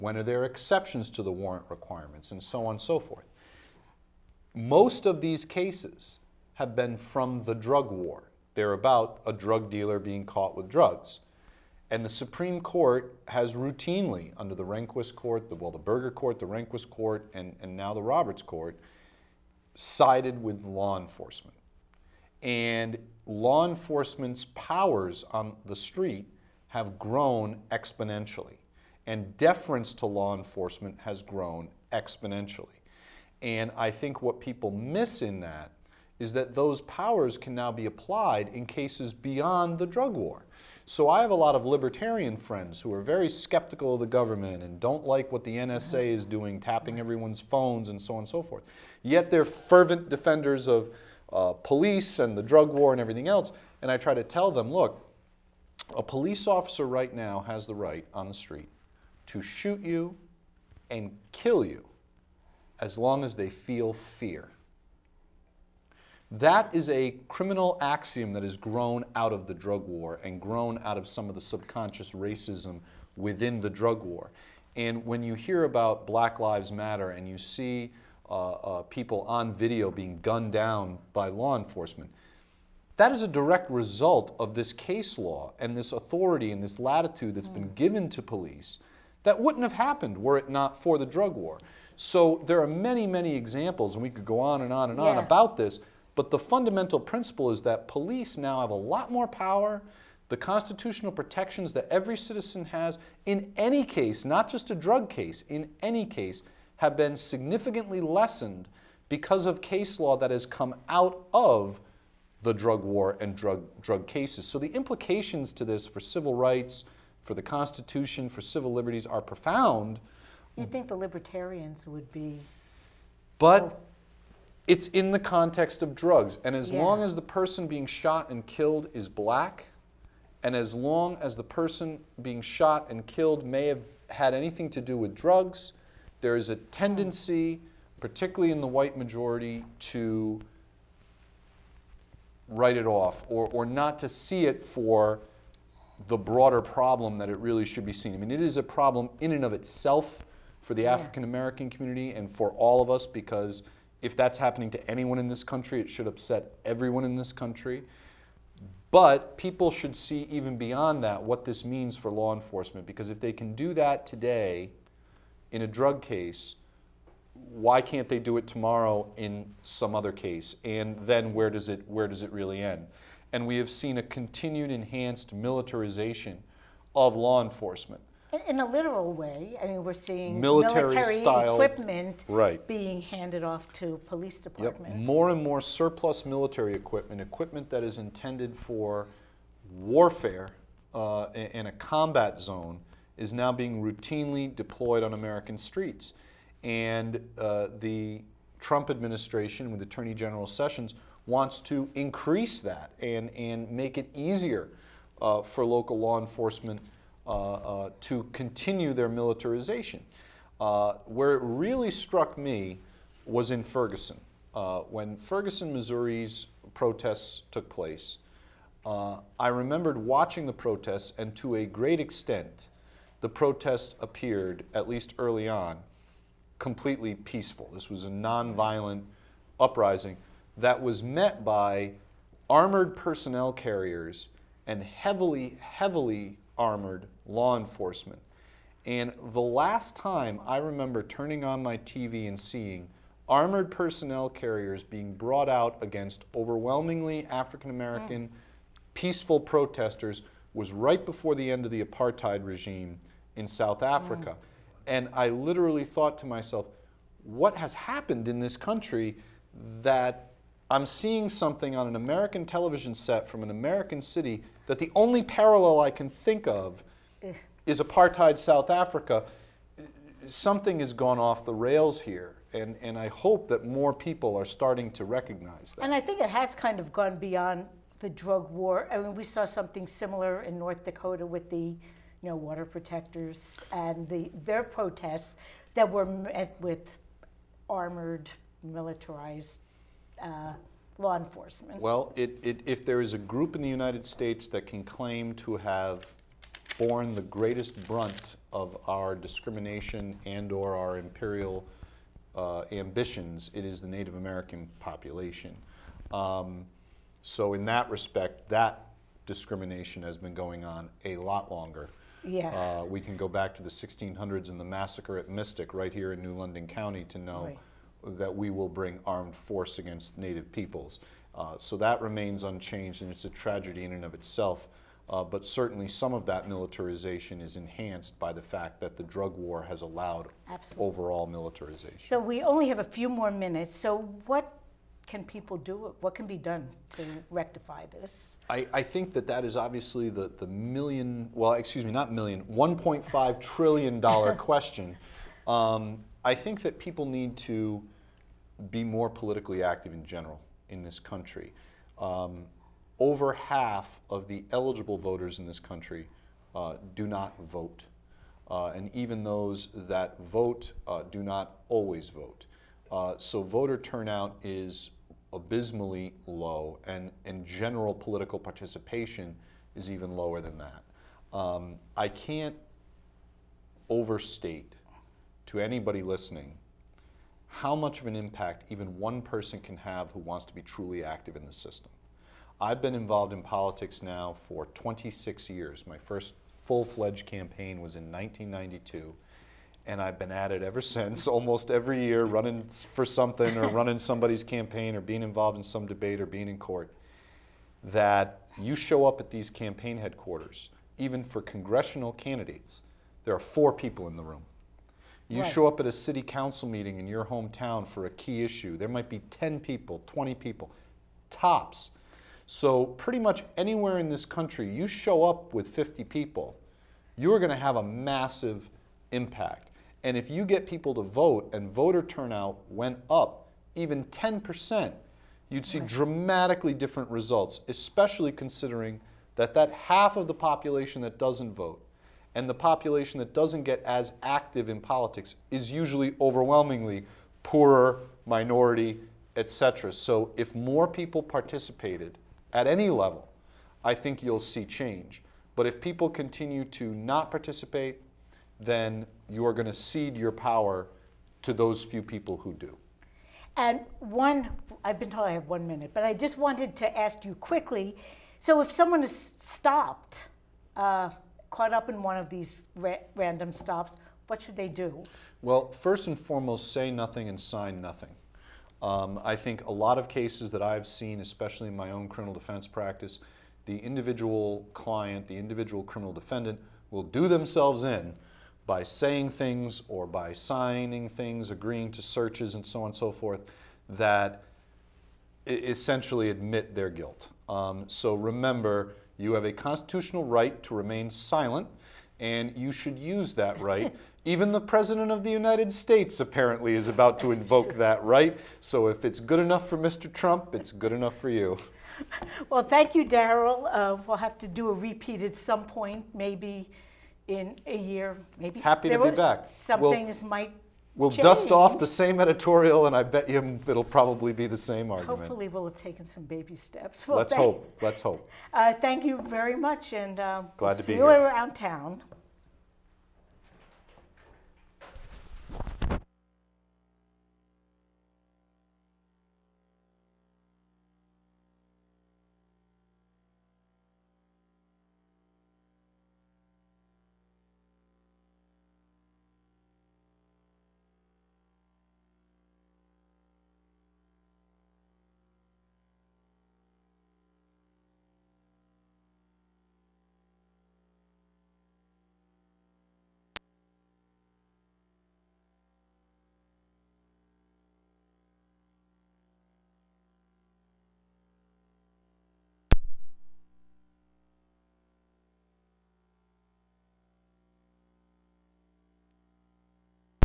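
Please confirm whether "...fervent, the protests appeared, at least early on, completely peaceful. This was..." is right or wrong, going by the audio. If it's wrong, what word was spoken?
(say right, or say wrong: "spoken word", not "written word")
wrong: "extent", not "fervent".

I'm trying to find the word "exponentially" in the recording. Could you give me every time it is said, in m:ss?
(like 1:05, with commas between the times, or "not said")
0:27, 0:31.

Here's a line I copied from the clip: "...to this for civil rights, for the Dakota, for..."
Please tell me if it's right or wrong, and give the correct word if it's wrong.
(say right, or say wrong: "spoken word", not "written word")
wrong: "Constitution", not "Dakota".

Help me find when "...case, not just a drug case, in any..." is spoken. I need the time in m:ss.
1:43.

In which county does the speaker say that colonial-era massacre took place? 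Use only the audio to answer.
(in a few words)
New London County.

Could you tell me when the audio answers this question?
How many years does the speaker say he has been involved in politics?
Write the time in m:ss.
6:24.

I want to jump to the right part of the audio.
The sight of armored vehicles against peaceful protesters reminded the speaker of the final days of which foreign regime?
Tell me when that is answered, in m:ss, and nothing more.
4:11.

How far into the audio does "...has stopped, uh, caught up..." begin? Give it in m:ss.
7:39.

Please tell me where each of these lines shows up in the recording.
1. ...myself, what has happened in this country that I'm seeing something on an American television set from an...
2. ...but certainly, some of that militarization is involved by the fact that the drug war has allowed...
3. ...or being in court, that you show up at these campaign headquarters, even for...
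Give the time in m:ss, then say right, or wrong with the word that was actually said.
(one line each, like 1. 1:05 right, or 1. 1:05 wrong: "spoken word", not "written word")
1. 4:16 right
2. 5:25 wrong: "enhanced", not "involved"
3. 6:36 right.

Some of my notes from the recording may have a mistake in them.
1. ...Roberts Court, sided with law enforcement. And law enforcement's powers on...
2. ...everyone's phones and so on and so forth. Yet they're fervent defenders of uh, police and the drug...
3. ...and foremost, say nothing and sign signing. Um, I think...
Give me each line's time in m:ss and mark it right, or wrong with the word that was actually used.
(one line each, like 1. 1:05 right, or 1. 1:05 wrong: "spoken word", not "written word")
1. 0:18 right
2. 0:46 right
3. 7:46 wrong: "nothing", not "signing".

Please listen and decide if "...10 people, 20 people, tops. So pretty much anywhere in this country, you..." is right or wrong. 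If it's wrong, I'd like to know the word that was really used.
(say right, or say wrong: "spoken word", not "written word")
right.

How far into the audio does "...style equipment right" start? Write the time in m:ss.
3:01.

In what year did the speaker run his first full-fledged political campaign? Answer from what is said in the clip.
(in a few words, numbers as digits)
1992.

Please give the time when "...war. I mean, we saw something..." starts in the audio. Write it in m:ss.
4:38.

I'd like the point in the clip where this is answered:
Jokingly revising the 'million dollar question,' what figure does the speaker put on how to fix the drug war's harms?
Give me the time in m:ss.
5:42.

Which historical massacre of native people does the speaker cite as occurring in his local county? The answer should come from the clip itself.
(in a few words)
Mystic.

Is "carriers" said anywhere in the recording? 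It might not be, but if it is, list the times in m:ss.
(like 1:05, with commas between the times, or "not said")
3:53, 4:04.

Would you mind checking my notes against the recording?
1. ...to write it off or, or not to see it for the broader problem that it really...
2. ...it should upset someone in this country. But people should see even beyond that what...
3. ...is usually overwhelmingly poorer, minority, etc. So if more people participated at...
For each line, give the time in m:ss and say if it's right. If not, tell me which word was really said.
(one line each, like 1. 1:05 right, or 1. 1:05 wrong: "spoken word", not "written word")
1. 2:19 right
2. 2:35 wrong: "everyone", not "someone"
3. 7:15 right.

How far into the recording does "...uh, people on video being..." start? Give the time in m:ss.
1:18.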